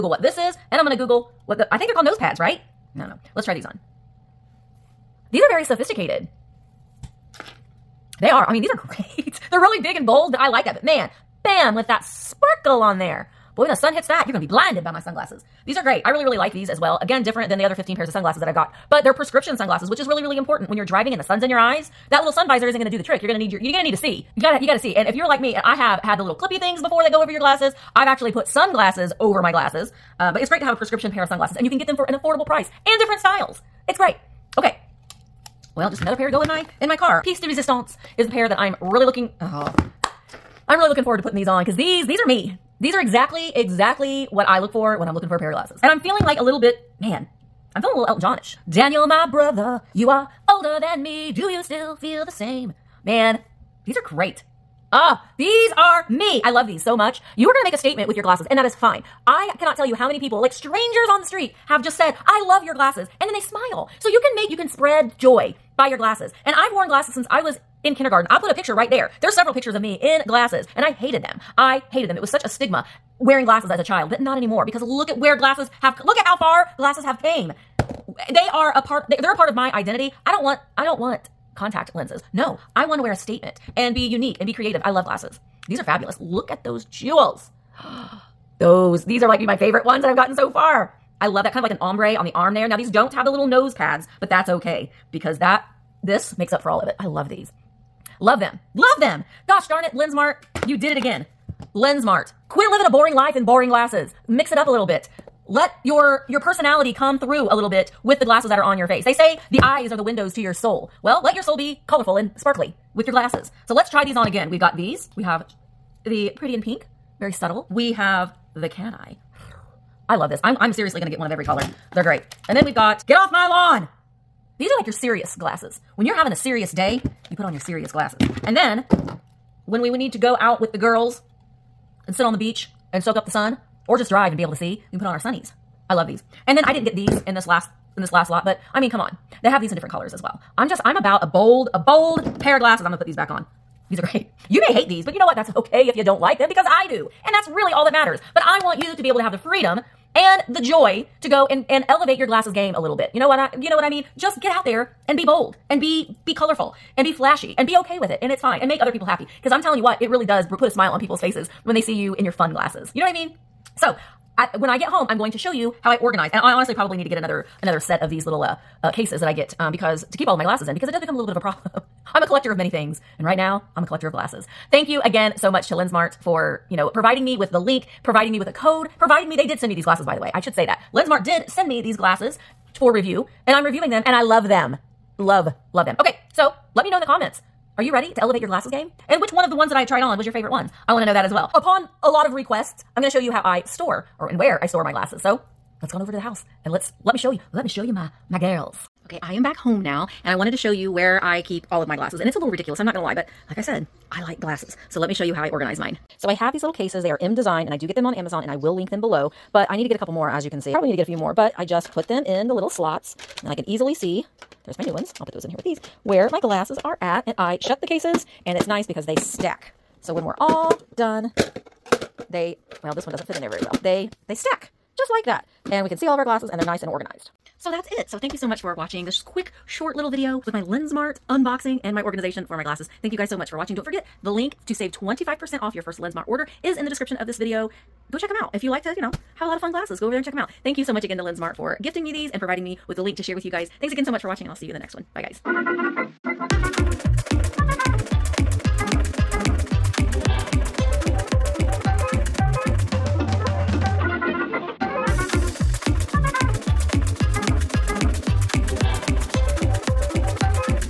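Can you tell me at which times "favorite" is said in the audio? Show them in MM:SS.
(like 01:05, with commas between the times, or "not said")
01:29, 03:10.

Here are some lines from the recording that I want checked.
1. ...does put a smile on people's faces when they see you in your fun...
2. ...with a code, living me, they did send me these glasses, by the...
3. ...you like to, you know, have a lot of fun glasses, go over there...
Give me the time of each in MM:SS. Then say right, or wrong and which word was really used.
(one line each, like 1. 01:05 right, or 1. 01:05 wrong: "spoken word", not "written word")
1. 02:40 right
2. 02:58 wrong: "providing", not "living"
3. 03:58 right.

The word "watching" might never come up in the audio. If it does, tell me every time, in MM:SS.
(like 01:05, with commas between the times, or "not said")
03:48, 03:53, 04:04.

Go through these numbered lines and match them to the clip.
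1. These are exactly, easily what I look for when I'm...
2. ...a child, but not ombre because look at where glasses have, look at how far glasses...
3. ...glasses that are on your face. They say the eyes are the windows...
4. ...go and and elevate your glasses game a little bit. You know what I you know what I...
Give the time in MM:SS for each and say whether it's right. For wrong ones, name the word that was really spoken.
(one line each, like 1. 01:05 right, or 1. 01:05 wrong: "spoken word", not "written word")
1. 00:42 wrong: "exactly", not "easily"
2. 01:13 wrong: "anymore", not "ombre"
3. 01:48 right
4. 02:31 right.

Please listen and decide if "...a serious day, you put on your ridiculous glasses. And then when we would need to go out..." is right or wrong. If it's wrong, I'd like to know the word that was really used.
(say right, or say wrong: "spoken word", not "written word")
wrong: "serious", not "ridiculous".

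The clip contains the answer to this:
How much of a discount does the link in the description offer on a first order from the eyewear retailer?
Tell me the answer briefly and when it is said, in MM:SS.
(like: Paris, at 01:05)
25%, at 03:54.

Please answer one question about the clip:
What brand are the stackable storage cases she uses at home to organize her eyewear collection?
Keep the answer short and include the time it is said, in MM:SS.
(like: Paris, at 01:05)
mDesign, at 03:27.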